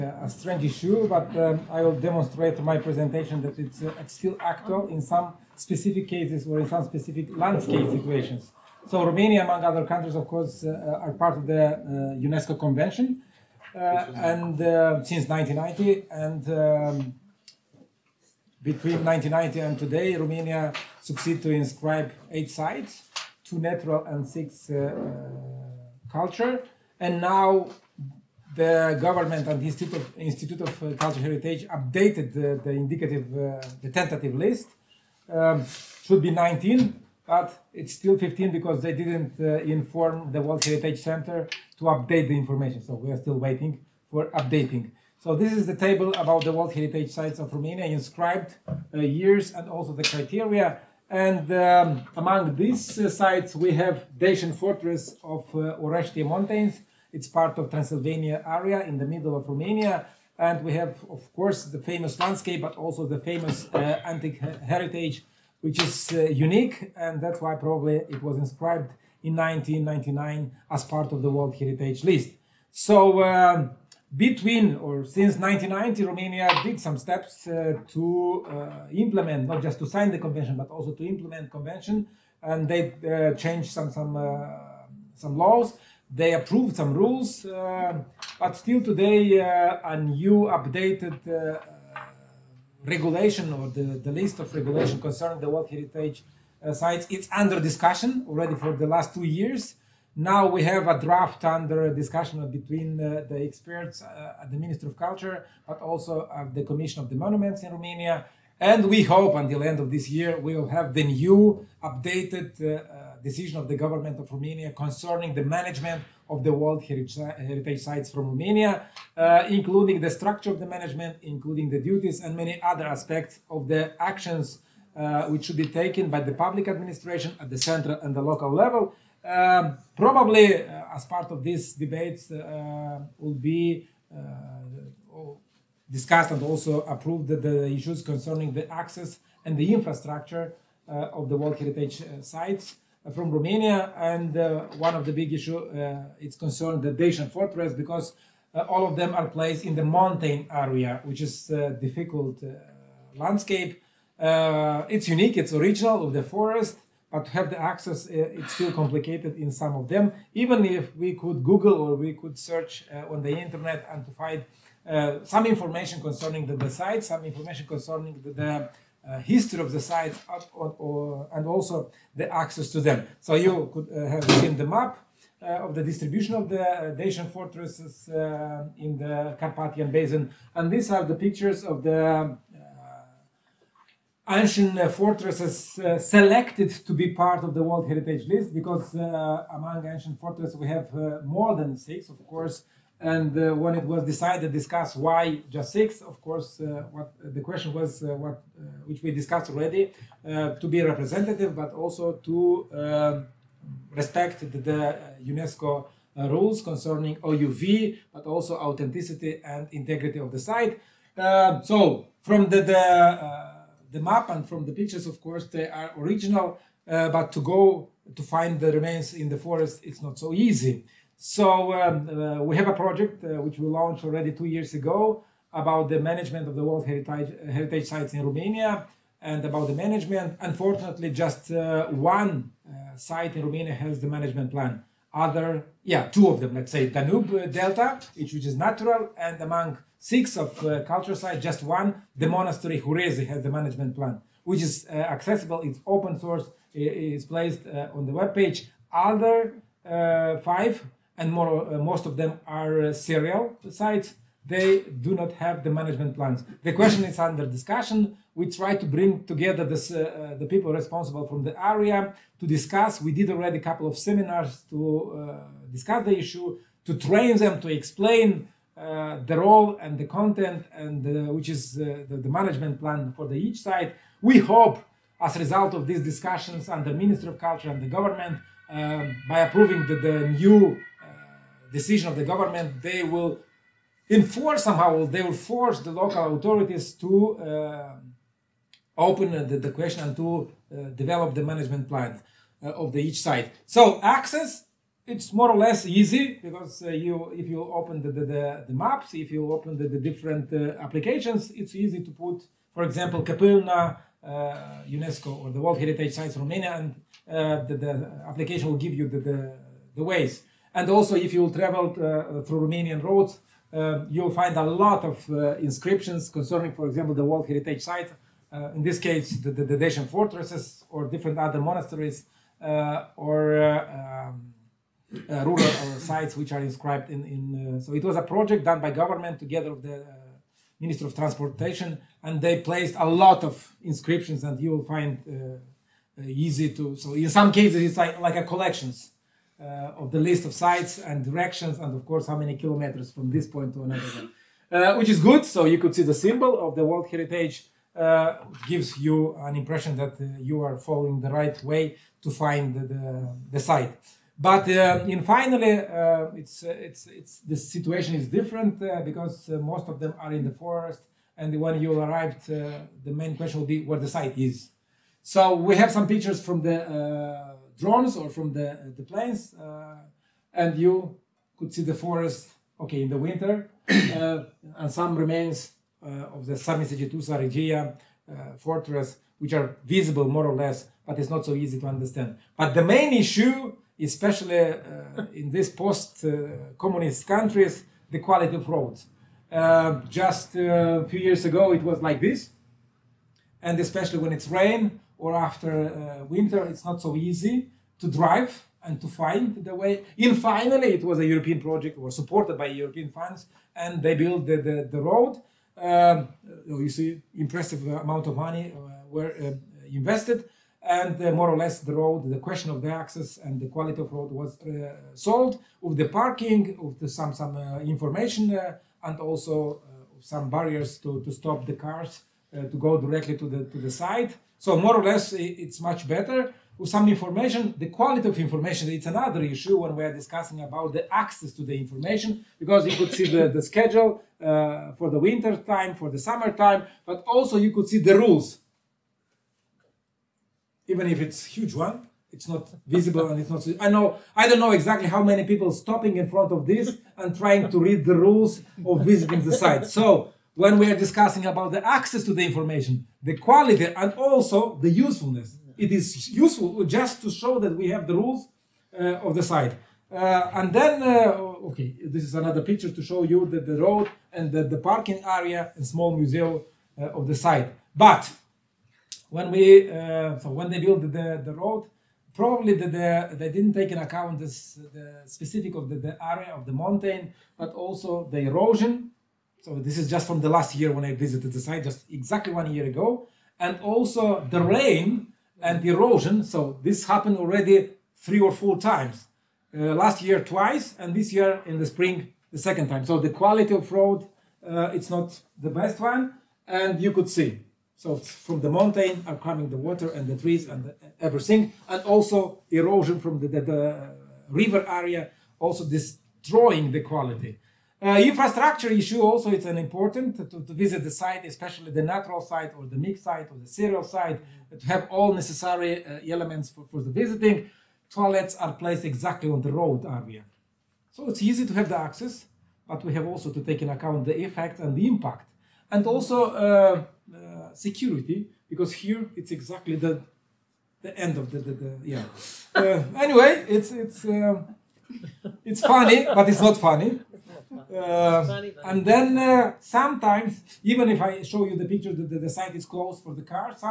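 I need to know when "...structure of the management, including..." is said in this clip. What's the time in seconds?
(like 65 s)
120 s.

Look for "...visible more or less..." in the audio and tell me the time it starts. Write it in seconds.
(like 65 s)
379 s.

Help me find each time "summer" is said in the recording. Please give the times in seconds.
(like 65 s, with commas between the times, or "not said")
436 s.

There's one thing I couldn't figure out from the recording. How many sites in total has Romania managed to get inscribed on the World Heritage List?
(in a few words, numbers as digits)
8.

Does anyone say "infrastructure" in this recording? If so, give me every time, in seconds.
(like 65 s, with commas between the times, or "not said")
139 s, 508 s.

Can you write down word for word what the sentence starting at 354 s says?
But uh, in finally, uh, it's, it's, it's, the situation is different because most of them are in the forest.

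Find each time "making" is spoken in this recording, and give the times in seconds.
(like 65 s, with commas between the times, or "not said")
not said.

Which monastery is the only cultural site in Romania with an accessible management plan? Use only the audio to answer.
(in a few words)
Hurezi.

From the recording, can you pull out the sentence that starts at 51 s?
And um, among these uh, sites, we have Dacian Fortress of uh, Mountains.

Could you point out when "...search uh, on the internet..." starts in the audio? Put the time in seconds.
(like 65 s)
162 s.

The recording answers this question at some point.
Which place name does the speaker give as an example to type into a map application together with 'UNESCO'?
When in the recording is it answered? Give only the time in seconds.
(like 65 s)
303 s.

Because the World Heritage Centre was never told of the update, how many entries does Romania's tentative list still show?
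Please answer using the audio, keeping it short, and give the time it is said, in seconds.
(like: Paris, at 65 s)
15, at 37 s.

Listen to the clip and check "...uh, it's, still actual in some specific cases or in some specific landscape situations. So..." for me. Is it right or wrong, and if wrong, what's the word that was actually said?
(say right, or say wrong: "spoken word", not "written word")
right.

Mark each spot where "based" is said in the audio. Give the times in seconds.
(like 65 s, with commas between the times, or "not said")
not said.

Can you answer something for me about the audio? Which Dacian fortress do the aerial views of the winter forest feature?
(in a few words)
Sarmisegetusa Regia.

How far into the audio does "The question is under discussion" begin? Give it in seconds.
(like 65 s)
256 s.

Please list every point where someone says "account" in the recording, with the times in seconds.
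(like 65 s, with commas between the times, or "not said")
473 s, 523 s.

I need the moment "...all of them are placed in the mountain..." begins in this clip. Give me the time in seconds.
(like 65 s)
148 s.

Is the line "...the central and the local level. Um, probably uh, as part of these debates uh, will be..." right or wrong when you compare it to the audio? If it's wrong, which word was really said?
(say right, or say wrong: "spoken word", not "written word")
right.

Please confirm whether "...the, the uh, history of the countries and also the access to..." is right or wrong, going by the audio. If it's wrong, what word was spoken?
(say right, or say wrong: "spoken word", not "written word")
wrong: "sites", not "countries".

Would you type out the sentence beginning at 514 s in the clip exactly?
to have all necessary uh, elements for, for the visiting.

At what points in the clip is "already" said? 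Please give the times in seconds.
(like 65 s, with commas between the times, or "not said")
98 s, 199 s, 224 s, 263 s, 487 s.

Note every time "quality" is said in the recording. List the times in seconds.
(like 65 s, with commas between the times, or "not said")
388 s, 413 s, 427 s, 453 s, 493 s, 507 s.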